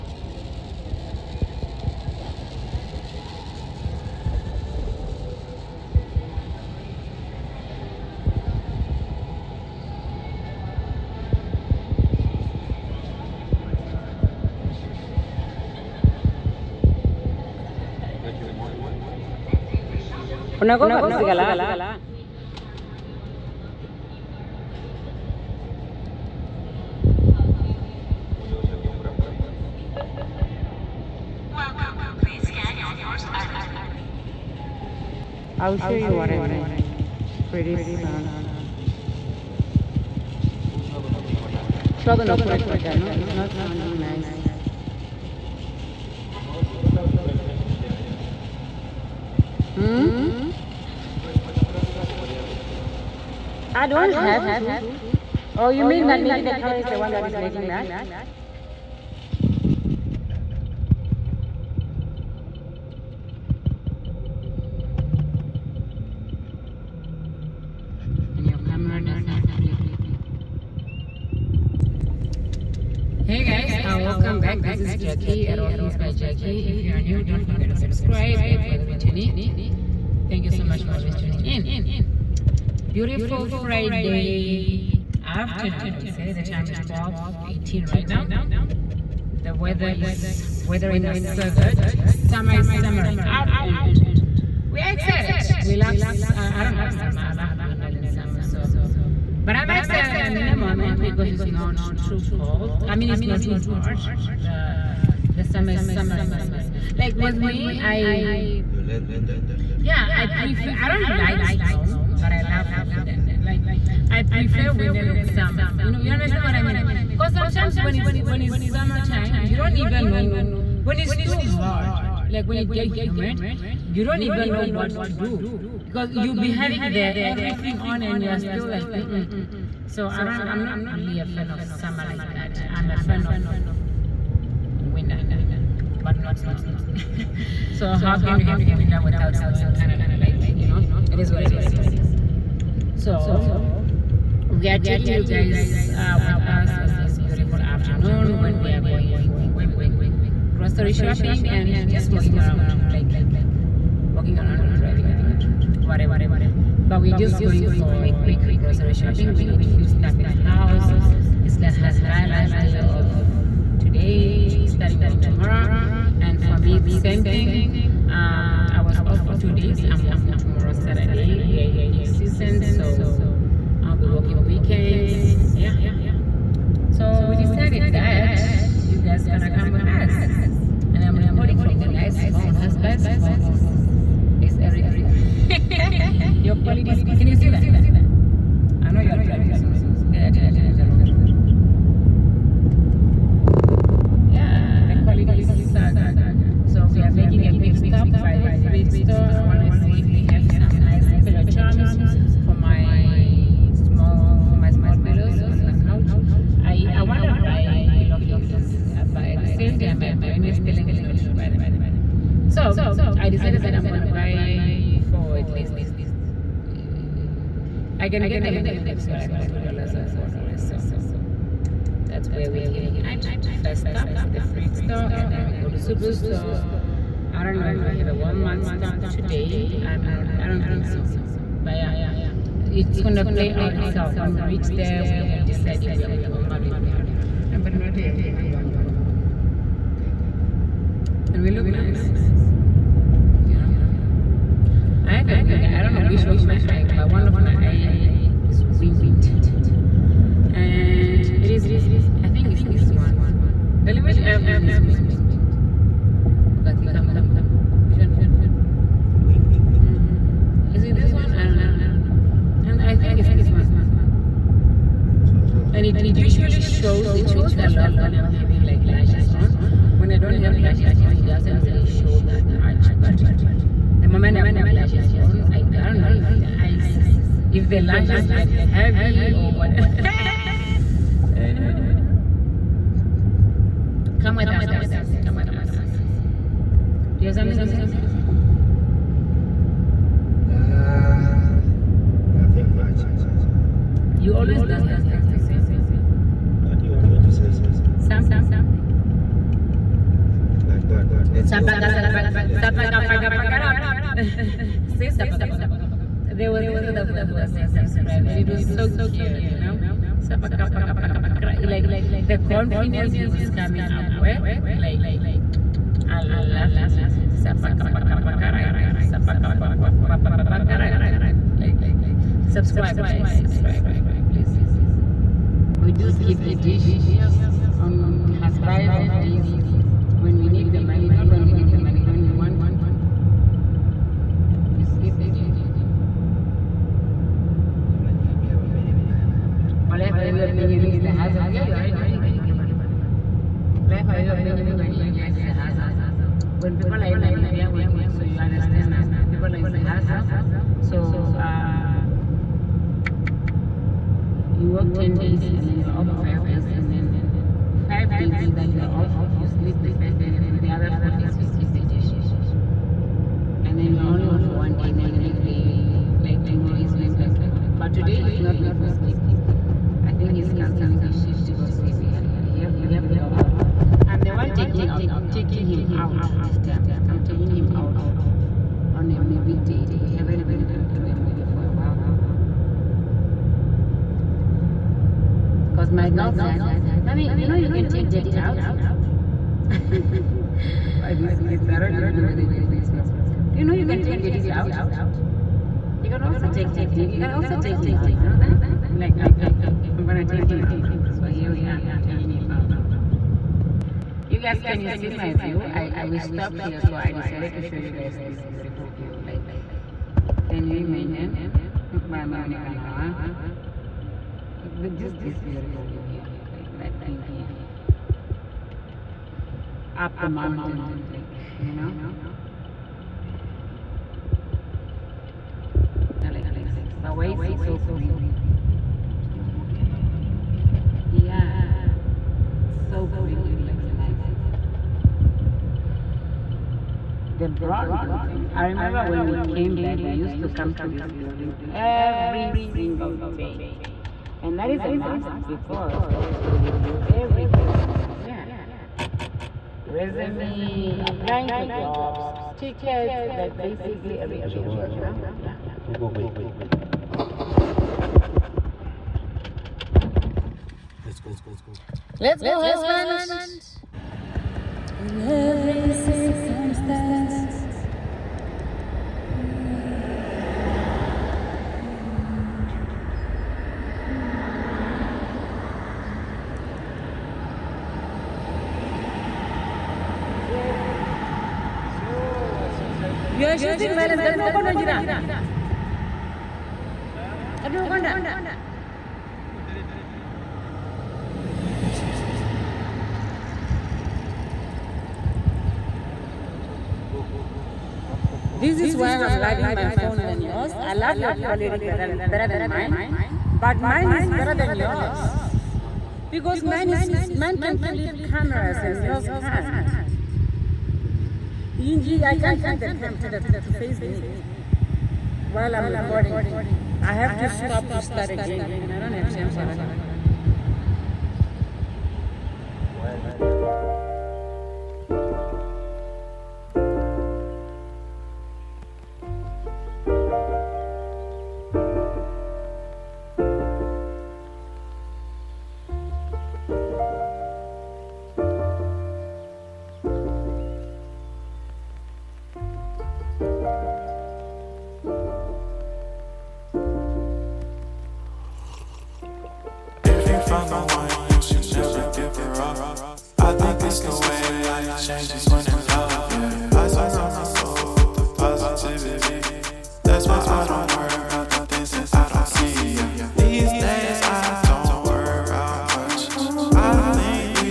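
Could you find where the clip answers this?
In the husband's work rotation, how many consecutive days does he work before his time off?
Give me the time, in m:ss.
5:54.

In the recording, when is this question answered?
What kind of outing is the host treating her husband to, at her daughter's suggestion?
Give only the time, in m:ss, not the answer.
6:19.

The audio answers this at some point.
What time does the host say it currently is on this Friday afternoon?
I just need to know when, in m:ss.
1:26.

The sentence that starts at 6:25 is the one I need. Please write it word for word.
Because my girl said, Mommy, you know you can take daddy out?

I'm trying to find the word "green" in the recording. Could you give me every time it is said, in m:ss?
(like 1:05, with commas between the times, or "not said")
7:07, 7:13.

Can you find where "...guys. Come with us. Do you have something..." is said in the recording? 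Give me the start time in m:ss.
4:44.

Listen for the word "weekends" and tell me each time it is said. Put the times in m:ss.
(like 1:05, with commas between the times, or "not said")
2:54.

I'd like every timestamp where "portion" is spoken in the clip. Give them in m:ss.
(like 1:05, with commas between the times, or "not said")
not said.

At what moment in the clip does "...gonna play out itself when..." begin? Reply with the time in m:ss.
3:52.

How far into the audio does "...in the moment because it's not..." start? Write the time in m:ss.
1:40.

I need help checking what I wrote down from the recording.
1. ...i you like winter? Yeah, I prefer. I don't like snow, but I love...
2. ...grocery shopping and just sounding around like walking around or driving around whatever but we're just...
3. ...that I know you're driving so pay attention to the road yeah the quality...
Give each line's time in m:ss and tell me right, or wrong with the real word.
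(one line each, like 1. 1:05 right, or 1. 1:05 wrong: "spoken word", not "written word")
1. 1:47 right
2. 2:30 wrong: "walking", not "sounding"
3. 3:07 right.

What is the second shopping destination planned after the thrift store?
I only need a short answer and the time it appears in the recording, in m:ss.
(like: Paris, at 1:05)
Superstore, at 3:45.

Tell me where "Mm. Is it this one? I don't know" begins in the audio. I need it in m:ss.
4:19.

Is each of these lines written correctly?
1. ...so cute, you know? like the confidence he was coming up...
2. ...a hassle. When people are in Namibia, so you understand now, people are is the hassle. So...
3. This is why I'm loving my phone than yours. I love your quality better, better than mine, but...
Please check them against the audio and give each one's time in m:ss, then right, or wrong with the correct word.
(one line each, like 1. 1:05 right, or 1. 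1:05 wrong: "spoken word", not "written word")
1. 5:08 right
2. 5:45 right
3. 8:18 right.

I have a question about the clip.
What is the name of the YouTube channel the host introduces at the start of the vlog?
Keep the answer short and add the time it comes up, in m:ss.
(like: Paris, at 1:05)
All Things by Jacky, at 1:15.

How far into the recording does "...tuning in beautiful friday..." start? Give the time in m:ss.
1:21.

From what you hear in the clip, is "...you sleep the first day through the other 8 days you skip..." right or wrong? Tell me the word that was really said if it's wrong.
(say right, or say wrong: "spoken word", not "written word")
wrong: "4", not "8".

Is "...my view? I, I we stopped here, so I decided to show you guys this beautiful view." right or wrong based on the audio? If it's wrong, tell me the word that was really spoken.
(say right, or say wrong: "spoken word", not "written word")
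right.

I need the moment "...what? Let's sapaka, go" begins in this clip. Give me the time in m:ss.
5:00.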